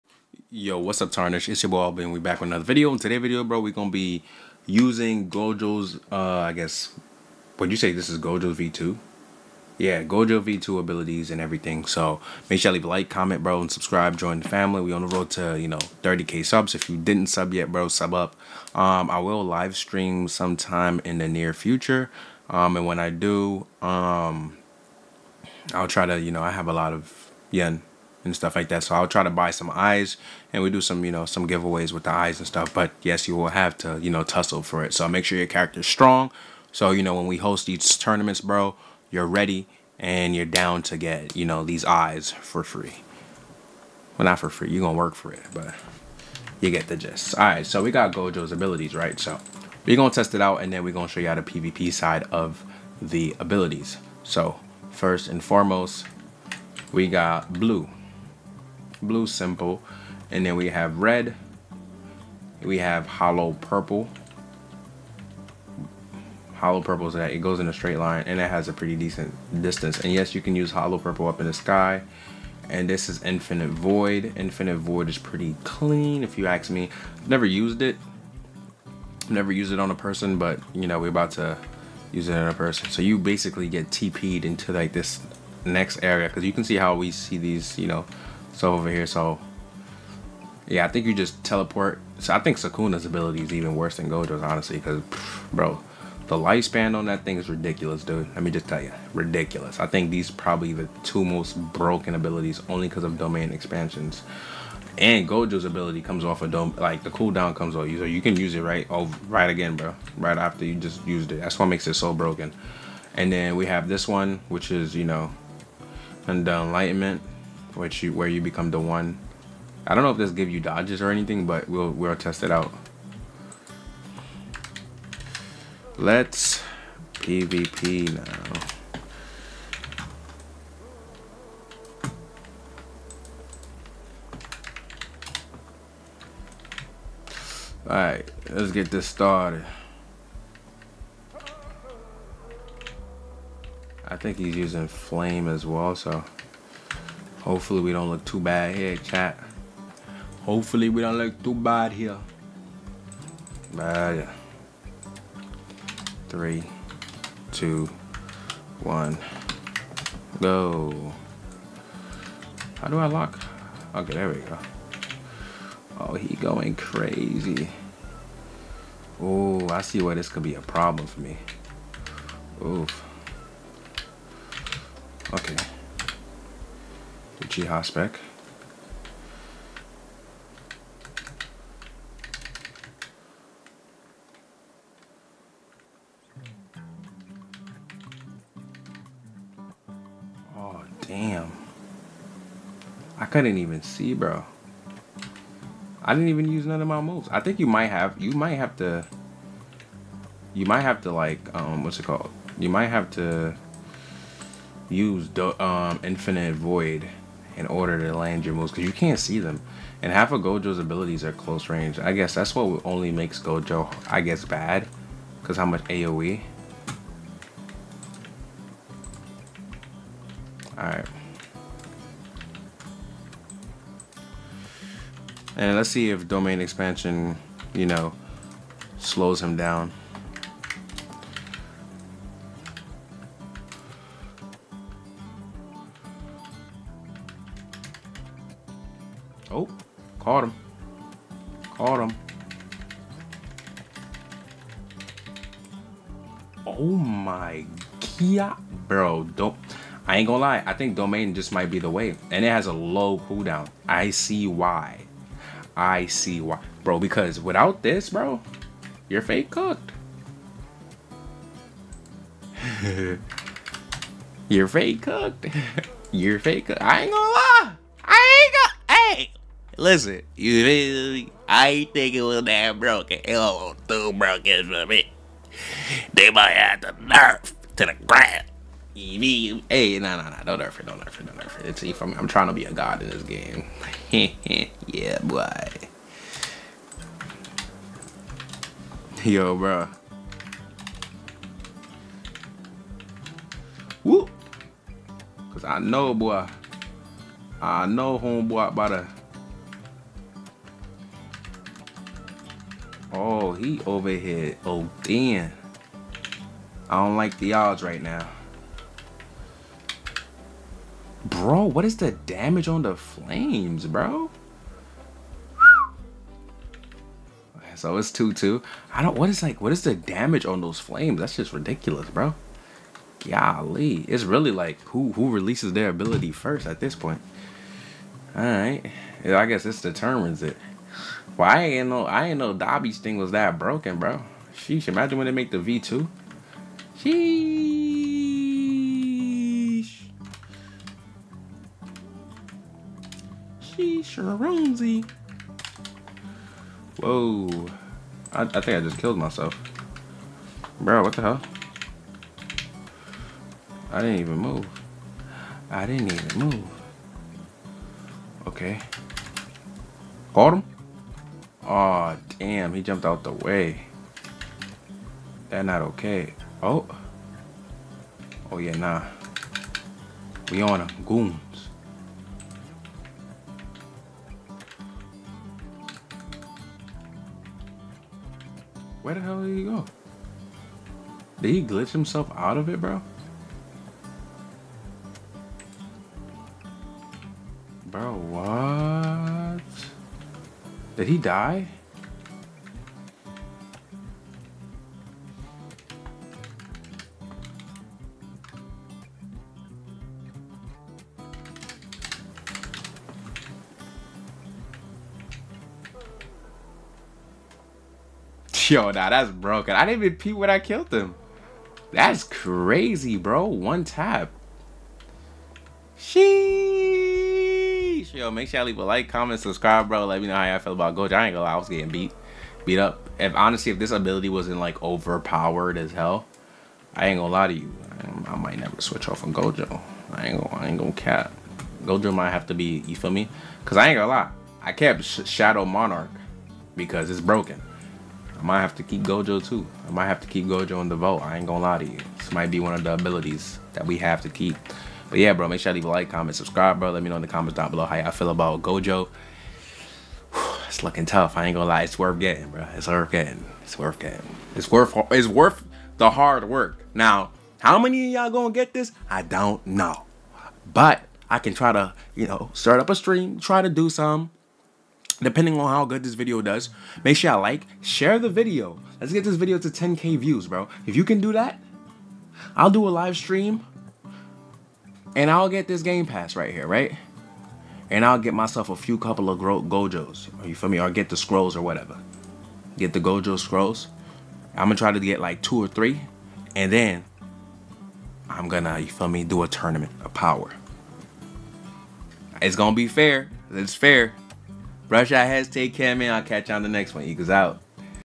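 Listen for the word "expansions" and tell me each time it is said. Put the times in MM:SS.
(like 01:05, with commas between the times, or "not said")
01:43, 03:46.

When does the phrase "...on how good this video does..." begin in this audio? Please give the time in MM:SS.
07:45.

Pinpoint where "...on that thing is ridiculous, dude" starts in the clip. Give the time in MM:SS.
01:36.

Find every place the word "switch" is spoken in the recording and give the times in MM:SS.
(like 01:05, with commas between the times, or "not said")
07:08.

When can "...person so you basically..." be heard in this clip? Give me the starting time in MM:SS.
01:22.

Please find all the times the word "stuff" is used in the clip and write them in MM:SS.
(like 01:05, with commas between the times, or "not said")
00:28, 00:32.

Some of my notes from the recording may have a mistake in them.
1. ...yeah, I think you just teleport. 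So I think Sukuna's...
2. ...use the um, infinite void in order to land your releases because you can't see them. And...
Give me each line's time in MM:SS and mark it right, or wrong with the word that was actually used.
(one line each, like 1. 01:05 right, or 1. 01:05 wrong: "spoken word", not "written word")
1. 01:30 right
2. 03:24 wrong: "moves", not "releases".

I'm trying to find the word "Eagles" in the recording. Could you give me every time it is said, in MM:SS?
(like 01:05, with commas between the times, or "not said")
08:17.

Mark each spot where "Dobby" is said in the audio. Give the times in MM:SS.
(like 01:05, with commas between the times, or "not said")
05:32.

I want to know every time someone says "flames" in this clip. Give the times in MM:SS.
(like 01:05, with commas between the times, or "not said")
02:24, 05:12, 05:20.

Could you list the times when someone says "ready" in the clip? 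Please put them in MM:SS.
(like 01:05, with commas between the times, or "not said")
00:39.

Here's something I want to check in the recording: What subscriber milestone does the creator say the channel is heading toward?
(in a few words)
30k.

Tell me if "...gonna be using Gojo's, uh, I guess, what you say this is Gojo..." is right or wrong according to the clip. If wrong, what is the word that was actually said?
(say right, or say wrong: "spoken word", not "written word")
right.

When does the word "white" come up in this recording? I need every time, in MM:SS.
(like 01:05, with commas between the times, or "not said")
not said.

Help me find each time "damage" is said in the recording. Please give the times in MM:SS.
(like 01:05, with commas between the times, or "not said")
05:12, 05:19.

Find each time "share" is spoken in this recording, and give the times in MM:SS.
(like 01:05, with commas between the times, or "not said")
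07:47.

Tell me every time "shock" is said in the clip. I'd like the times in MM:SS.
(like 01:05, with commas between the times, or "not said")
not said.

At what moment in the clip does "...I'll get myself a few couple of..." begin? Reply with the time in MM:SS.
07:58.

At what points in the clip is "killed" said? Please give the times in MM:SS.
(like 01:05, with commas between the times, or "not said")
05:48, 06:50.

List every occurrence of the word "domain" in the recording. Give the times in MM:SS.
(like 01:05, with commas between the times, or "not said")
01:43, 03:46, 04:10.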